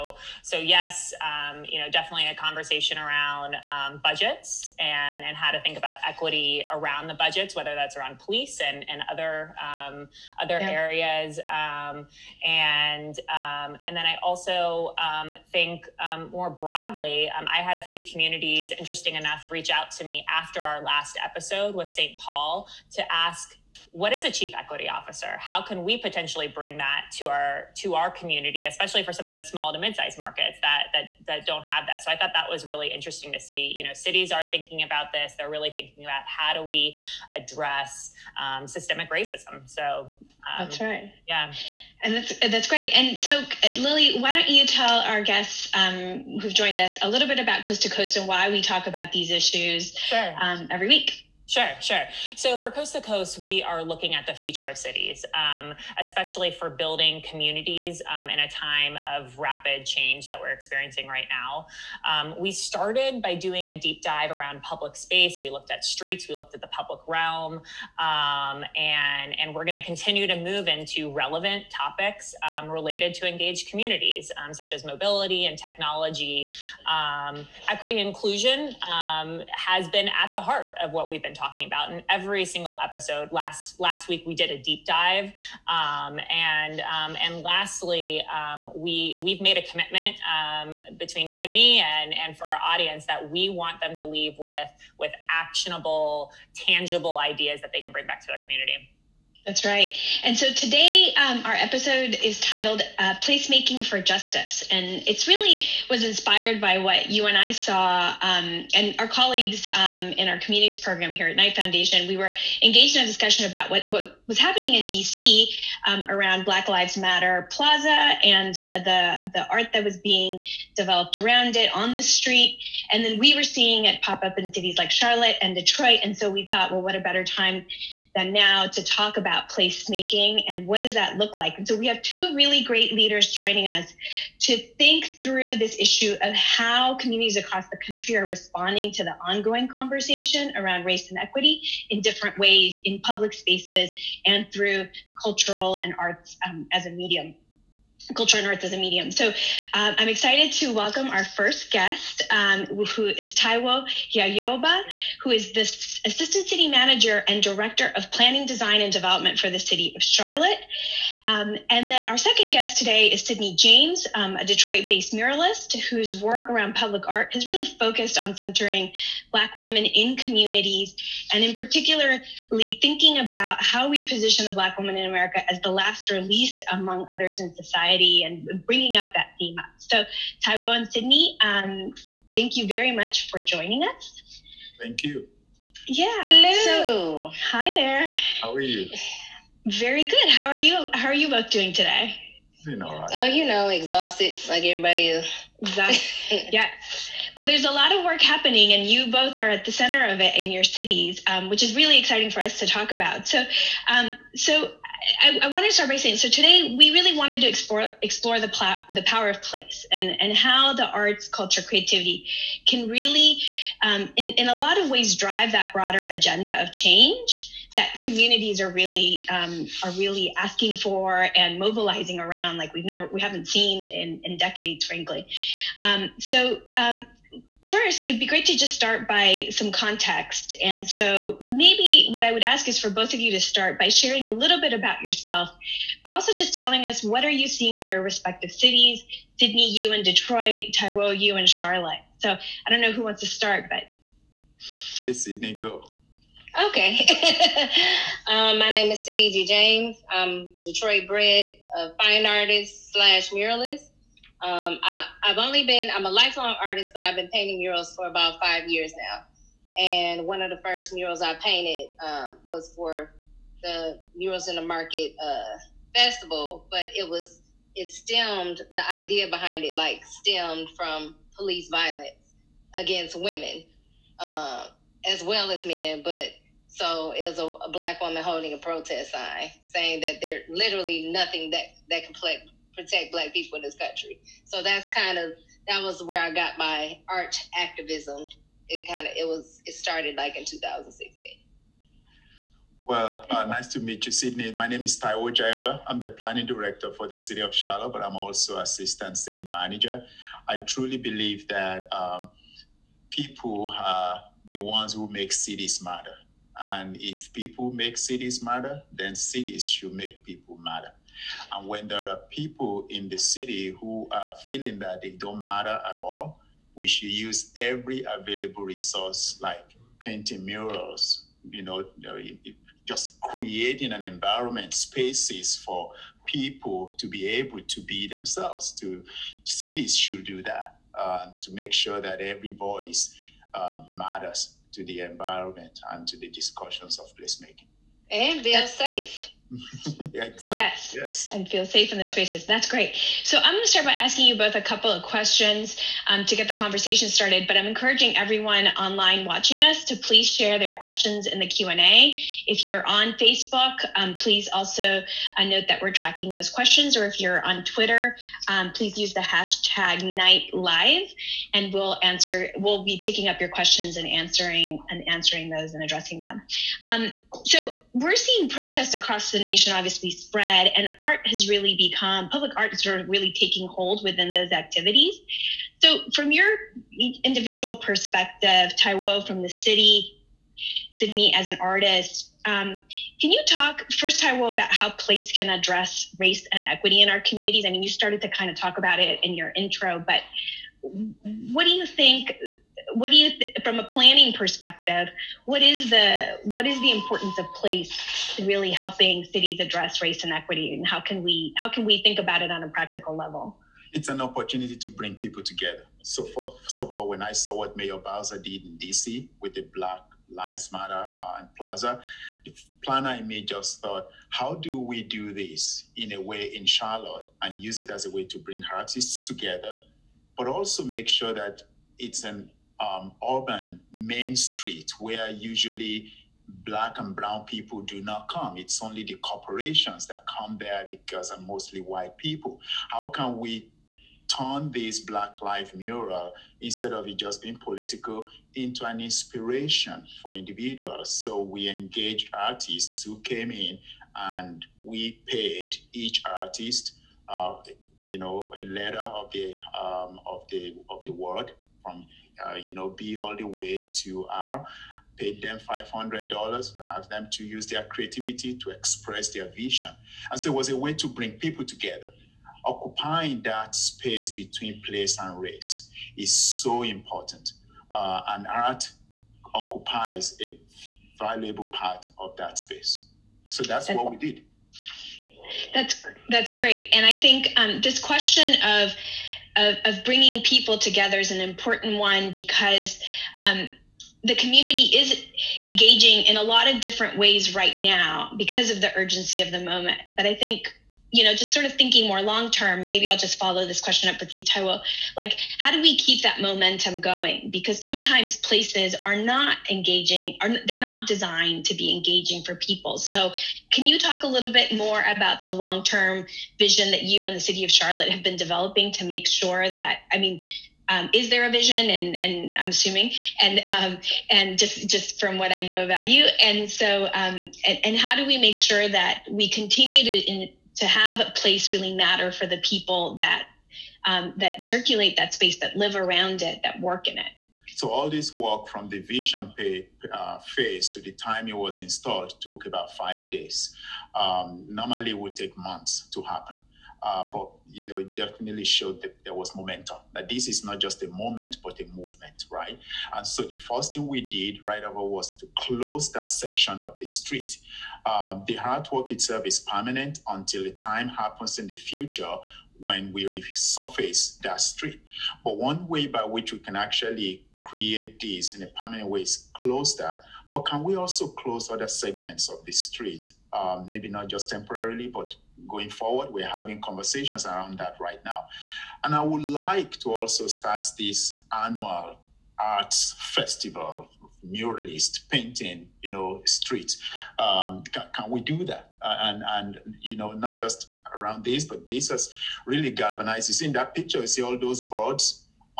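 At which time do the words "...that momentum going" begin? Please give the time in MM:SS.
08:16.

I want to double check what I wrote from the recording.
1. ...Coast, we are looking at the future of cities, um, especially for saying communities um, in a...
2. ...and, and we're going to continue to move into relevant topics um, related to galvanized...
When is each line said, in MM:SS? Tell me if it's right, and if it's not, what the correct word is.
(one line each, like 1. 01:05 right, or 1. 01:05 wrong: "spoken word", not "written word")
1. 00:53 wrong: "building", not "saying"
2. 01:08 wrong: "engaged", not "galvanized".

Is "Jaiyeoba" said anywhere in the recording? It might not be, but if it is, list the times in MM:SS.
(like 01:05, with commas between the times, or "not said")
02:34, 04:55.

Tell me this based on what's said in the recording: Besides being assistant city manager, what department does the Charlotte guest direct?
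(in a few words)
planning, design, and development.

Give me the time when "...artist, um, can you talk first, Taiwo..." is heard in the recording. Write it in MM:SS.
06:21.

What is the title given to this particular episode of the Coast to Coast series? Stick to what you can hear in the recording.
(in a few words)
Placemaking for Justice.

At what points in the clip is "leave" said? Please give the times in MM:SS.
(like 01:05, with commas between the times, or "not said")
01:34.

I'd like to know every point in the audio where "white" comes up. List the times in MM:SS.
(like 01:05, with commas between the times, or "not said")
07:11.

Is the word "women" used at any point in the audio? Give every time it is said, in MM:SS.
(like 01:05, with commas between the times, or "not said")
02:49, 04:33.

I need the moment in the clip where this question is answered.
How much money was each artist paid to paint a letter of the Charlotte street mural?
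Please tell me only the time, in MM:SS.
07:35.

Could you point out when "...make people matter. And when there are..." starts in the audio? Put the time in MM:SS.
05:09.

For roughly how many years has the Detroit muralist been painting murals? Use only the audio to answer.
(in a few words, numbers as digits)
5 years.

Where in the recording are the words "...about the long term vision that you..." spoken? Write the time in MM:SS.
08:25.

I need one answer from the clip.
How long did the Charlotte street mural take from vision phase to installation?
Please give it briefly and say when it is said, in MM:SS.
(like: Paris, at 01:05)
about five days, at 08:52.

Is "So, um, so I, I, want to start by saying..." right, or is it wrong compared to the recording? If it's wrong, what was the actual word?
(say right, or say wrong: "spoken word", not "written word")
right.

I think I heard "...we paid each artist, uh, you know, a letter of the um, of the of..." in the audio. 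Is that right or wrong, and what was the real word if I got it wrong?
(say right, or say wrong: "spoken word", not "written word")
right.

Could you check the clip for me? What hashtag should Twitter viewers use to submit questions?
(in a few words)
Knight Live.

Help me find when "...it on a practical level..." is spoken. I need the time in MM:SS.
06:42.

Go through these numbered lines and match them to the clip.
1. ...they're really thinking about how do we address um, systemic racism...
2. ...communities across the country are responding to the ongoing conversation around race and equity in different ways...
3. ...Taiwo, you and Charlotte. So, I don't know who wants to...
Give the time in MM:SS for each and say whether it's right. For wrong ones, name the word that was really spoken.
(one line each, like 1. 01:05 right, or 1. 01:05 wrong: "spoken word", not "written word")
1. 00:35 right
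2. 02:16 right
3. 04:00 right.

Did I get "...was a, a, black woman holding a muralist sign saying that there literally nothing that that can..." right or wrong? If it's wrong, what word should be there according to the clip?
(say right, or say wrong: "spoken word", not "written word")
wrong: "protest", not "muralist".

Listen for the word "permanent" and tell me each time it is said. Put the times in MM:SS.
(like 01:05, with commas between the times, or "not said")
09:09, 09:18.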